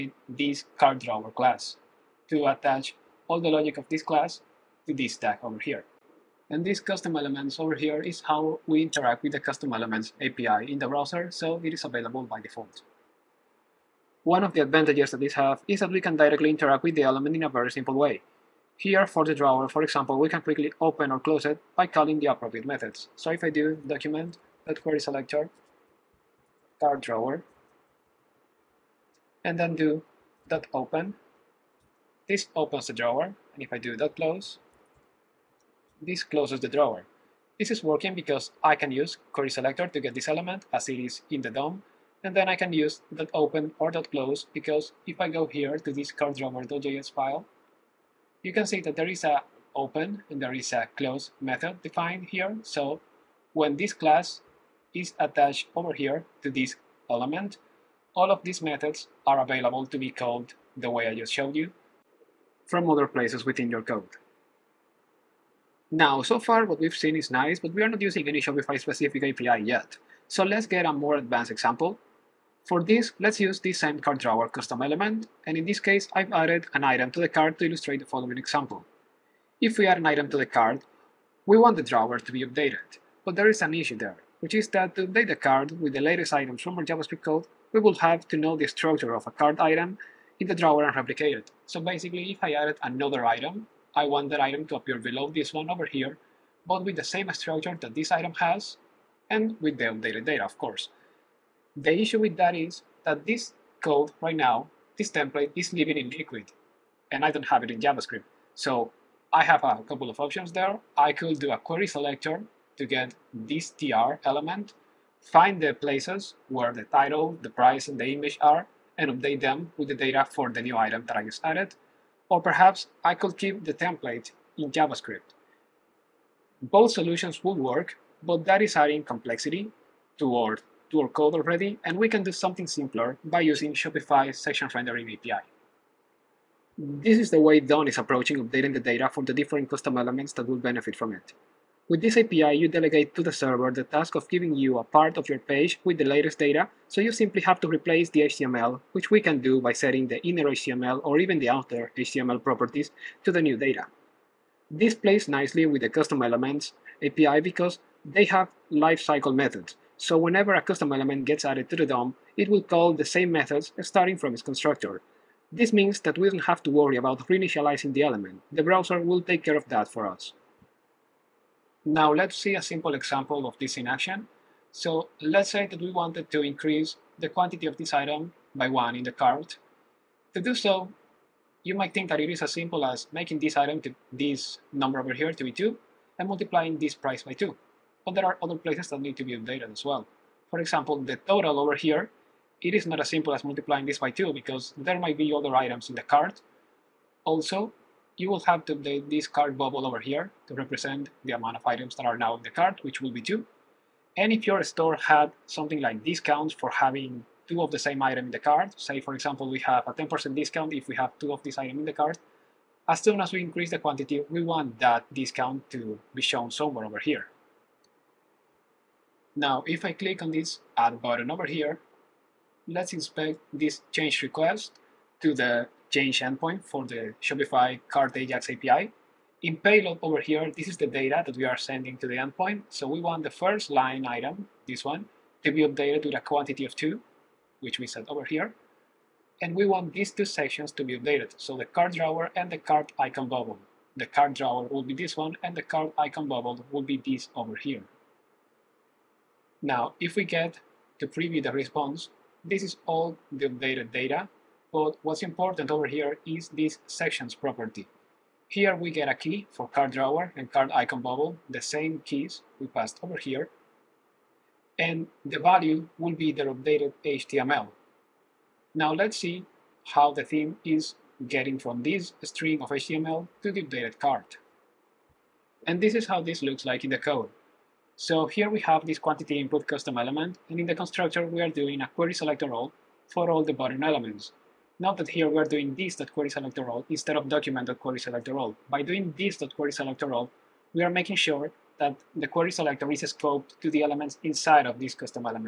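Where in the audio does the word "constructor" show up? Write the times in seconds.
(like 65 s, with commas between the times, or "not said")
164 s, 280 s.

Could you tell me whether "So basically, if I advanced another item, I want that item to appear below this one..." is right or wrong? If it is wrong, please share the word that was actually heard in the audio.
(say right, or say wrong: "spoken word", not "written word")
wrong: "added", not "advanced".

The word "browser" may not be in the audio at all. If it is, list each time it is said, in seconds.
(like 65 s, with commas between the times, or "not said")
10 s, 168 s.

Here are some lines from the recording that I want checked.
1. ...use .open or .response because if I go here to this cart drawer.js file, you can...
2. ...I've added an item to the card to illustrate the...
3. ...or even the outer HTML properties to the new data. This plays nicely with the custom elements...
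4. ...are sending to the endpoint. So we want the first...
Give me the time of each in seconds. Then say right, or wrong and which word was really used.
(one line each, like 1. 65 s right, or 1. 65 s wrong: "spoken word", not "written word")
1. 42 s wrong: "close", not "response"
2. 76 s right
3. 151 s right
4. 231 s right.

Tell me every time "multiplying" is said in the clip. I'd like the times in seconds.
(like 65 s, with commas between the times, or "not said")
186 s, 193 s.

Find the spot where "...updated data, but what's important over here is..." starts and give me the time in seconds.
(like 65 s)
253 s.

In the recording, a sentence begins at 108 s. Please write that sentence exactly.
So I have a couple of options there.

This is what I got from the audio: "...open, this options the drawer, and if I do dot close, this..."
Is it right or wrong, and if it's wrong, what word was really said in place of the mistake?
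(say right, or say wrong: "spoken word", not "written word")
wrong: "opens", not "options".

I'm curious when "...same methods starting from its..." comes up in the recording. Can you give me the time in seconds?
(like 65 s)
163 s.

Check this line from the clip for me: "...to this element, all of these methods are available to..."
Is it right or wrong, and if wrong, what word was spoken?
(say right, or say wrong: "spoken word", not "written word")
right.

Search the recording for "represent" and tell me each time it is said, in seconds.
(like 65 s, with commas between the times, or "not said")
200 s.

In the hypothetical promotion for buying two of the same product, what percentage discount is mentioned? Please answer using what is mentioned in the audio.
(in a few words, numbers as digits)
10%.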